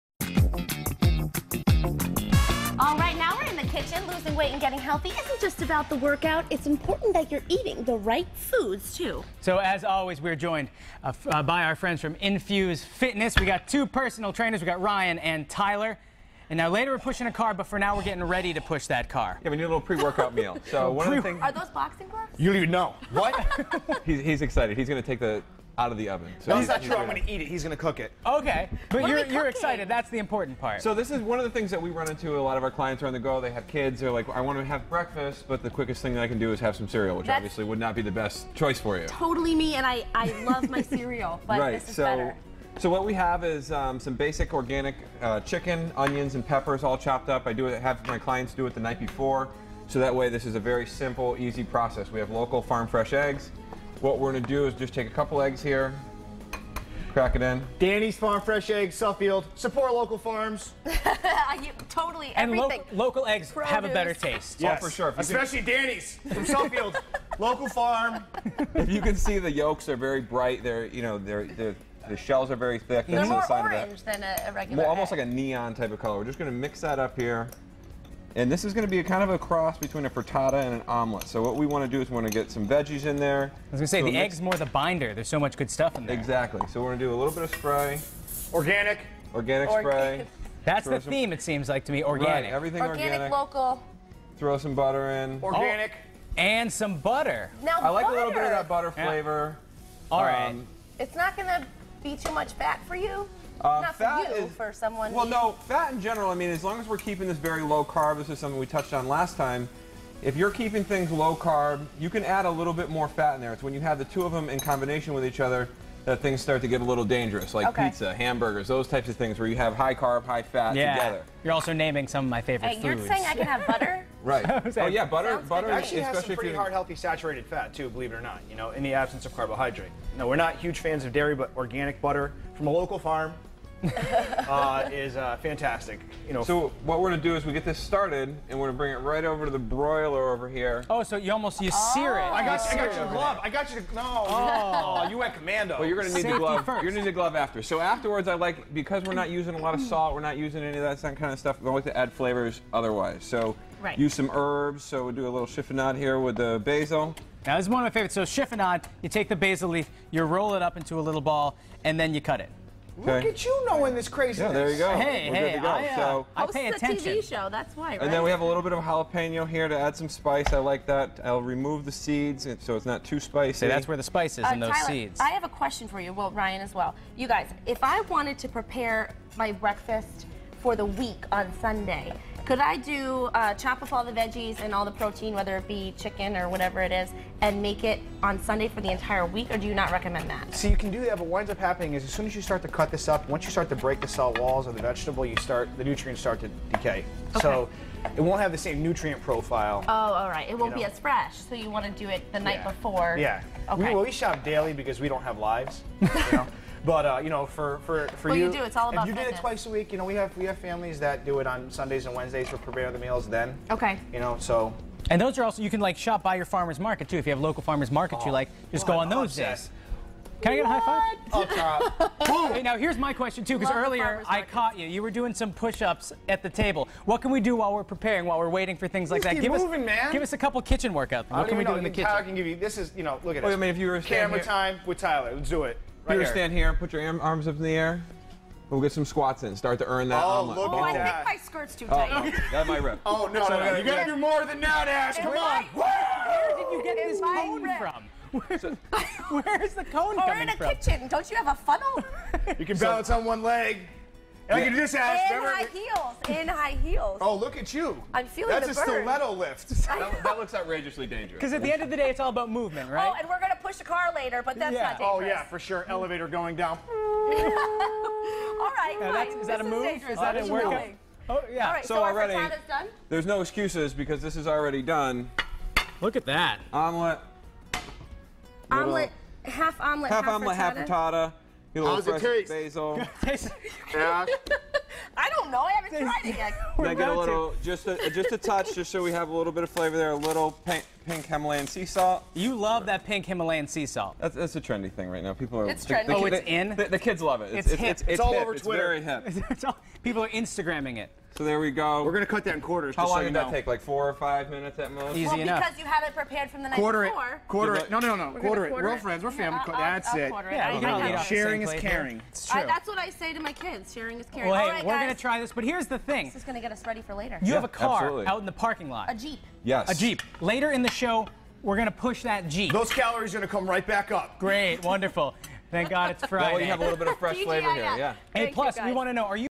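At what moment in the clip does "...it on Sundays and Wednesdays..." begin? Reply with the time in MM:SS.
03:31.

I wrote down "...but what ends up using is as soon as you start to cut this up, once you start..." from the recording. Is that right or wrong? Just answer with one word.
wrong.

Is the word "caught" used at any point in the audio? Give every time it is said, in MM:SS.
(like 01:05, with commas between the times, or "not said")
03:44.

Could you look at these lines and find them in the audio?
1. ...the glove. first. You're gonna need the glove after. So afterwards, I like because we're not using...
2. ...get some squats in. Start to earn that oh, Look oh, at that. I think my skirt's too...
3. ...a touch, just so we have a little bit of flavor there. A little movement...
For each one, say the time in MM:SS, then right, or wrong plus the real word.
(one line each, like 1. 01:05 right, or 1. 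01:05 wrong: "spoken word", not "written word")
1. 02:26 right
2. 03:58 right
3. 04:48 wrong: "paint", not "movement".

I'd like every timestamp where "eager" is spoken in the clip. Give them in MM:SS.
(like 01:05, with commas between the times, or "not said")
not said.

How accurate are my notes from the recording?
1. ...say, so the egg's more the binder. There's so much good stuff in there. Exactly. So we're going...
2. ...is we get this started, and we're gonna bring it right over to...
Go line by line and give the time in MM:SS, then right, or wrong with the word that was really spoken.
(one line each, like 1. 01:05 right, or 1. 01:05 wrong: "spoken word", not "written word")
1. 01:23 right
2. 02:17 right.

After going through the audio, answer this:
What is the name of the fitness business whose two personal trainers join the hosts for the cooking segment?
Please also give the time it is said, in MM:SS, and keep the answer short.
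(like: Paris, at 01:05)
Infuse Fitness, at 00:12.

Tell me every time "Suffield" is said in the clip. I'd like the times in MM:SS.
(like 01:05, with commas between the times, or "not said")
00:58, 01:06.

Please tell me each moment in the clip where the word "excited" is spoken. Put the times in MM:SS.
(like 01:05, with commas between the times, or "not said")
00:24, 00:29.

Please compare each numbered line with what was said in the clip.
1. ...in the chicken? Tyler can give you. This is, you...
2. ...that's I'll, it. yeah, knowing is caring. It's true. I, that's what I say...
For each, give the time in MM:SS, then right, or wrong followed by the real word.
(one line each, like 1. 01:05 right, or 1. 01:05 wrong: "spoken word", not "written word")
1. 03:51 wrong: "kitchen", not "chicken"
2. 05:09 wrong: "sharing", not "knowing".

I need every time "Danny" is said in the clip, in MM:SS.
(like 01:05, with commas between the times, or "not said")
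00:57, 01:05.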